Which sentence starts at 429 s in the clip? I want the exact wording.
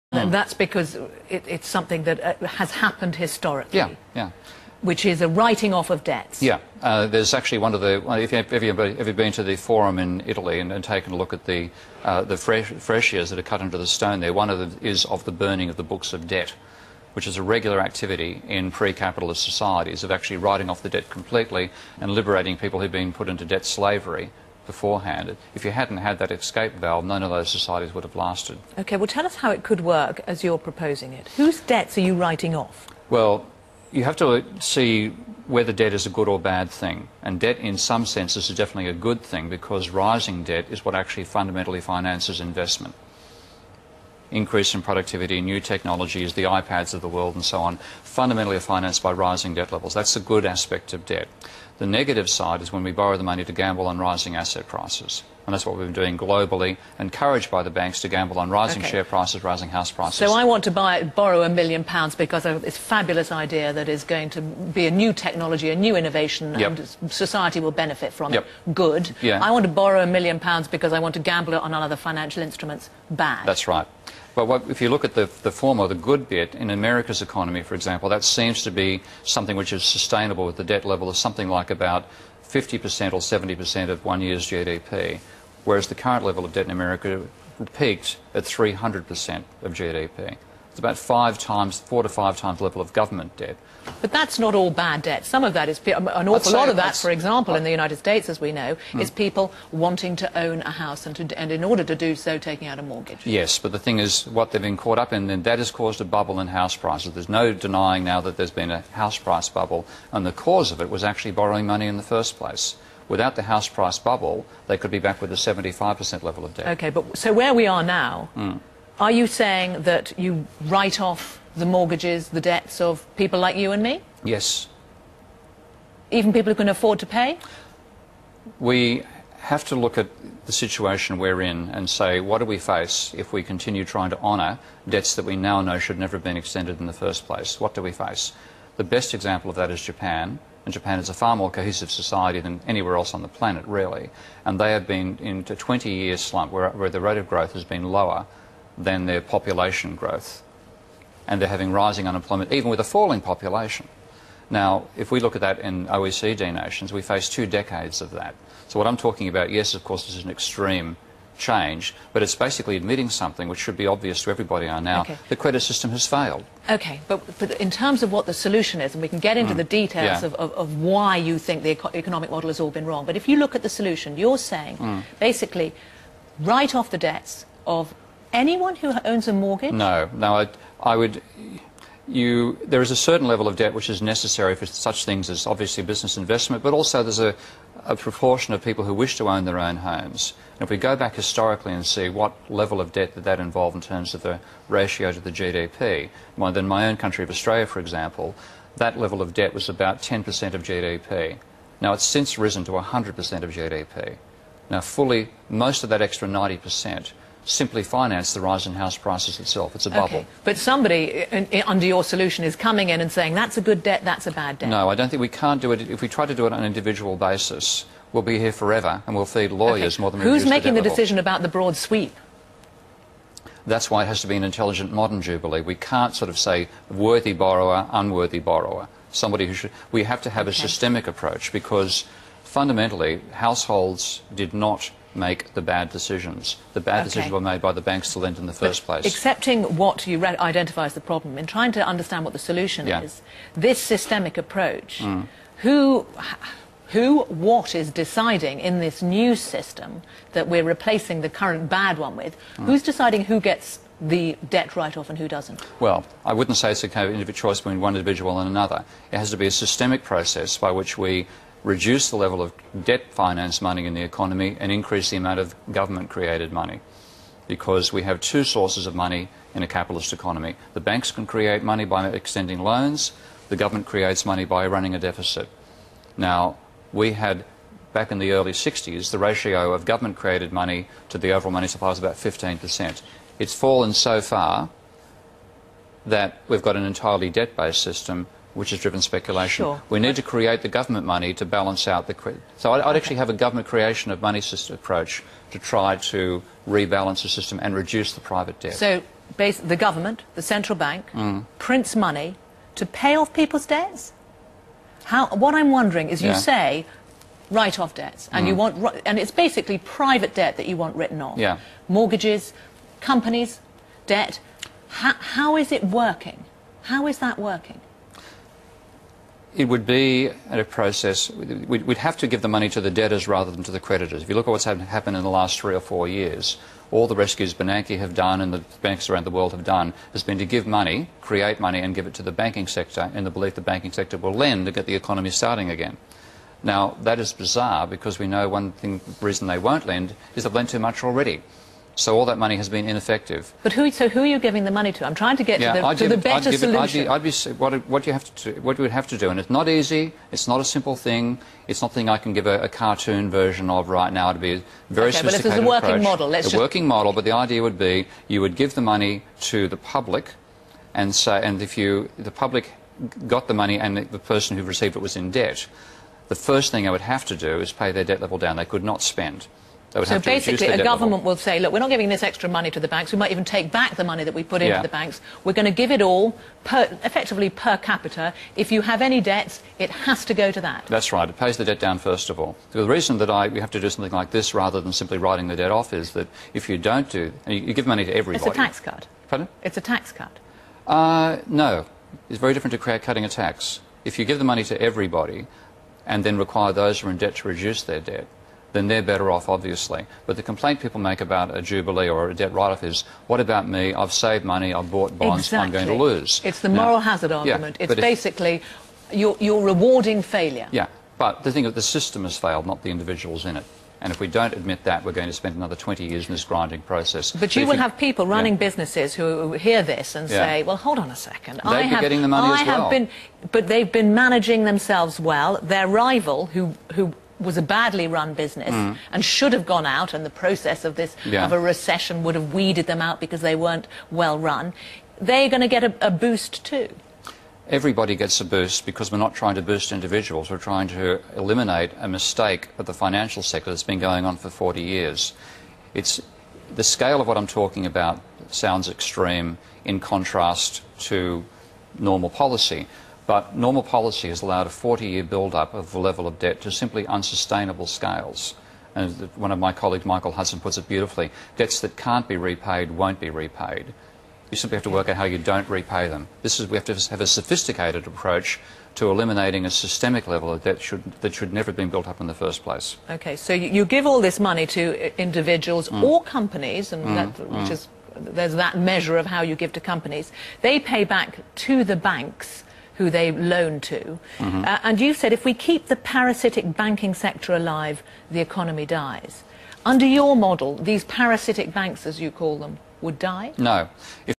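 and should have gone out and the process of this yeah.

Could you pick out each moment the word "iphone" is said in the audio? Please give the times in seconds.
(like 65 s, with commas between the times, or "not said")
not said.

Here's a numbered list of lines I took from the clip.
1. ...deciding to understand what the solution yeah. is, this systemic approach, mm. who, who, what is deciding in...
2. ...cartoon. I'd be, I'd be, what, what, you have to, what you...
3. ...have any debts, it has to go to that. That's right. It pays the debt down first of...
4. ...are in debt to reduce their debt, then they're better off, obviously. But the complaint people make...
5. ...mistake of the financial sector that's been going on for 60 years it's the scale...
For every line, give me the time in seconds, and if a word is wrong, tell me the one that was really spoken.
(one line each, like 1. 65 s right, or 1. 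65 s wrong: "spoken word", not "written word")
1. 241 s wrong: "trying", not "deciding"
2. 346 s wrong: "solution", not "cartoon"
3. 378 s right
4. 397 s right
5. 442 s wrong: "40", not "60".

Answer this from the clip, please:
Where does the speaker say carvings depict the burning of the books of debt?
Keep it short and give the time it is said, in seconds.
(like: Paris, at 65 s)
the Forum in Italy, at 9 s.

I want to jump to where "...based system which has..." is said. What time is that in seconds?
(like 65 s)
287 s.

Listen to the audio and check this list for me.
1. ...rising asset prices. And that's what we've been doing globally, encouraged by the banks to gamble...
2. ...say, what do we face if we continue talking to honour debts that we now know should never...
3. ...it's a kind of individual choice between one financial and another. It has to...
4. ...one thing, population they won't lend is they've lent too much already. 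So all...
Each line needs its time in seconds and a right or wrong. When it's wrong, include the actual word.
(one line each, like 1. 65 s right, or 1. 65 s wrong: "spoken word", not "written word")
1. 53 s right
2. 131 s wrong: "trying", not "talking"
3. 256 s wrong: "individual", not "financial"
4. 338 s wrong: "reason", not "population".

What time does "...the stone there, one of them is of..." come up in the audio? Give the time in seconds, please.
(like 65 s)
13 s.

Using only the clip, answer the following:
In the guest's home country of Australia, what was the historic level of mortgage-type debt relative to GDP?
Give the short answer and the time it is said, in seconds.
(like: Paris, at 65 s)
10%, at 200 s.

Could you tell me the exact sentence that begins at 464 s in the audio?
You simply have to work out how you don't repay them.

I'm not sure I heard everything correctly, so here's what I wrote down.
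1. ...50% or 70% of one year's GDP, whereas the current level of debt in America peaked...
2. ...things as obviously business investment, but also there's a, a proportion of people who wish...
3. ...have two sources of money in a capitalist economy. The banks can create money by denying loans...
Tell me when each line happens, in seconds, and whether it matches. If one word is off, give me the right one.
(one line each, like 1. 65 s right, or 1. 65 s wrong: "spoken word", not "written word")
1. 82 s right
2. 185 s right
3. 268 s wrong: "extending", not "denying".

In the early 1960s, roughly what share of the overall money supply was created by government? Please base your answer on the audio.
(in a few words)
15%.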